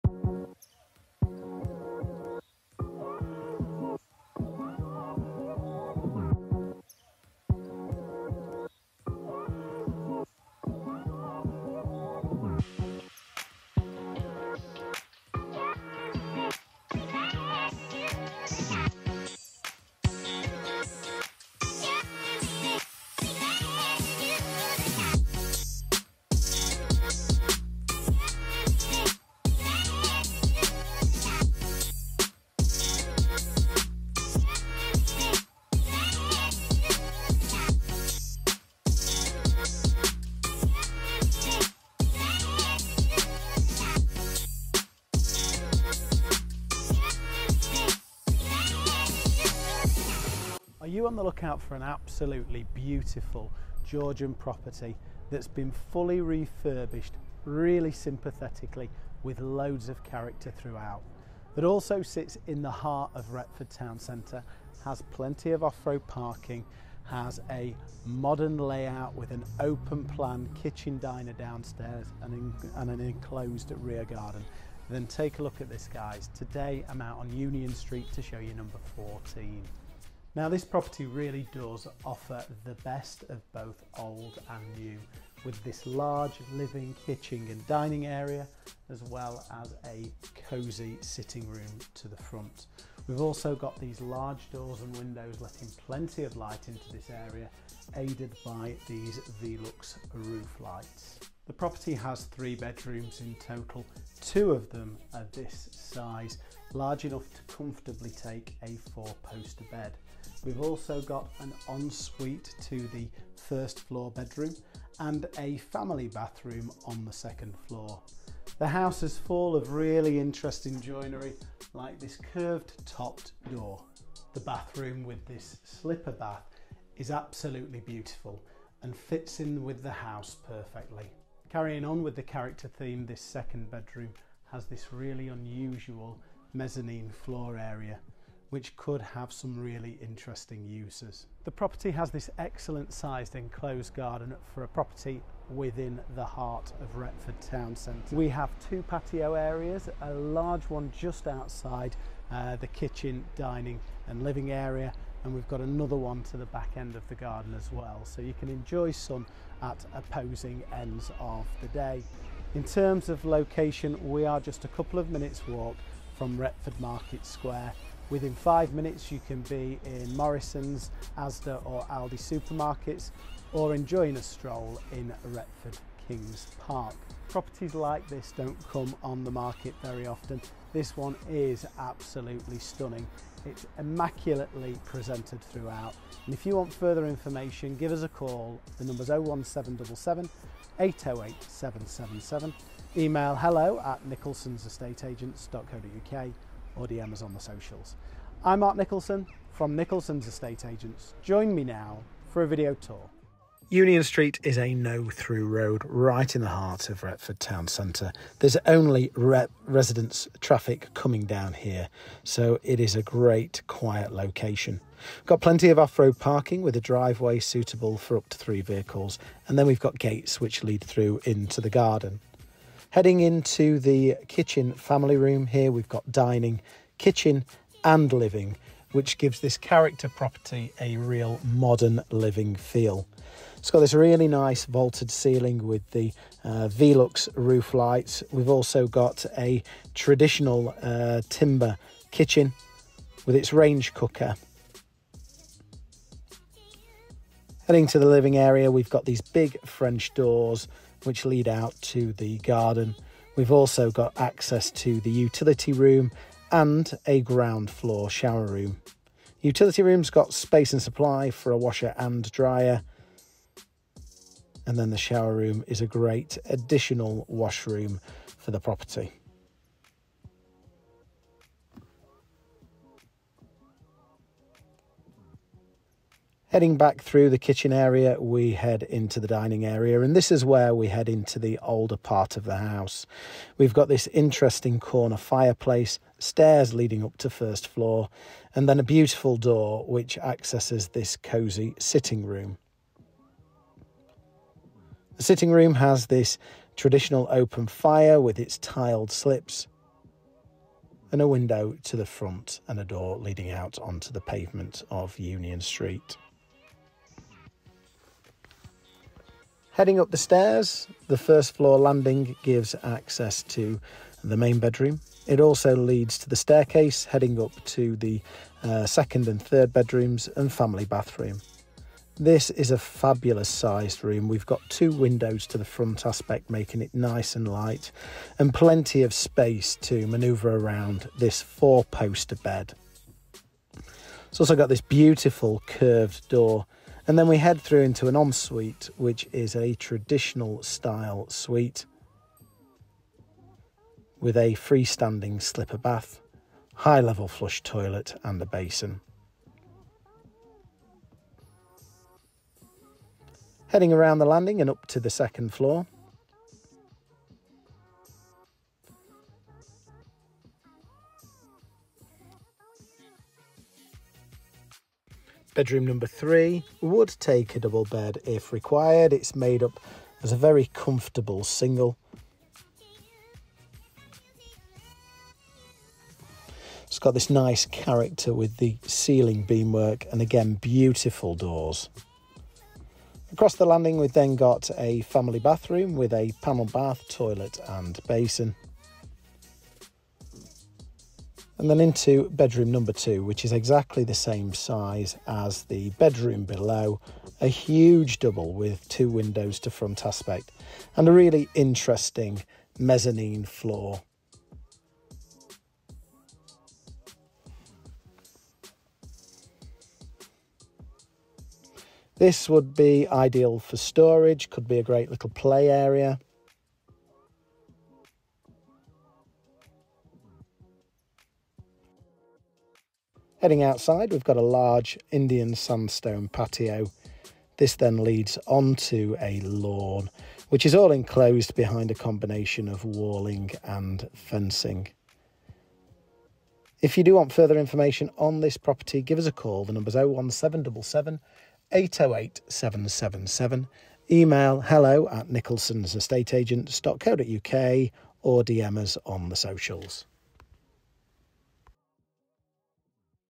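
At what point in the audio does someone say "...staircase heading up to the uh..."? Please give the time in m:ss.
5:16.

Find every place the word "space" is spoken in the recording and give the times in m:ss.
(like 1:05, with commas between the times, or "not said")
4:20, 5:29.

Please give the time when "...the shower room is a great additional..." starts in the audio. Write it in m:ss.
4:24.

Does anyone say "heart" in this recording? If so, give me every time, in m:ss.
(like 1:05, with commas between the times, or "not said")
1:02, 2:26, 3:26.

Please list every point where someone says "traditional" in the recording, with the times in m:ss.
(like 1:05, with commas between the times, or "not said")
3:59, 4:56, 5:39.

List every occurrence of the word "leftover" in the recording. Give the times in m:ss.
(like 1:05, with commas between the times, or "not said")
not said.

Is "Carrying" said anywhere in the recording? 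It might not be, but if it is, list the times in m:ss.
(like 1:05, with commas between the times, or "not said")
2:11.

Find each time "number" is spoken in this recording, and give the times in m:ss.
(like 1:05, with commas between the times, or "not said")
1:18, 3:08, 6:05, 6:32, 7:19.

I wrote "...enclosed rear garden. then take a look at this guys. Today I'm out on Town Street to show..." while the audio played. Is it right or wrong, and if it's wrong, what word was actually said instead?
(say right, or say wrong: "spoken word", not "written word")
wrong: "Union", not "Town".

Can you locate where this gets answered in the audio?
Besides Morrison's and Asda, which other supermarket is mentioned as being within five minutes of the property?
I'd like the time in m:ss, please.
2:51.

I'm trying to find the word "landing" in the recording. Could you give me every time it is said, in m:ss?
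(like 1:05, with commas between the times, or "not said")
5:11, 5:54, 6:23.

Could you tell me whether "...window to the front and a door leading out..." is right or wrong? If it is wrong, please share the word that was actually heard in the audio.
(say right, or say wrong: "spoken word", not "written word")
right.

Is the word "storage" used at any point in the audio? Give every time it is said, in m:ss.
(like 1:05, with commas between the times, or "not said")
6:53.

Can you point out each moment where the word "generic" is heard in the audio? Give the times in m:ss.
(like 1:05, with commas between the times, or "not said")
not said.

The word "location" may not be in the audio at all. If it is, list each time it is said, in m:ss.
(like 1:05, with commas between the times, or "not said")
2:43, 3:34.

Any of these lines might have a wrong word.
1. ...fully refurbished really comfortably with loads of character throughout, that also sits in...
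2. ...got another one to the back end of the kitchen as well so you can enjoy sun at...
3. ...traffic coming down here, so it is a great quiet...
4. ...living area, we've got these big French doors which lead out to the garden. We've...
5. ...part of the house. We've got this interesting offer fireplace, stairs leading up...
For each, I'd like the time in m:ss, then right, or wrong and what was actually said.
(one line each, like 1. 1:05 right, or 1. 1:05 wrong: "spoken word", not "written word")
1. 0:55 wrong: "sympathetically", not "comfortably"
2. 2:35 wrong: "garden", not "kitchen"
3. 3:30 right
4. 4:08 right
5. 4:41 wrong: "corner", not "offer".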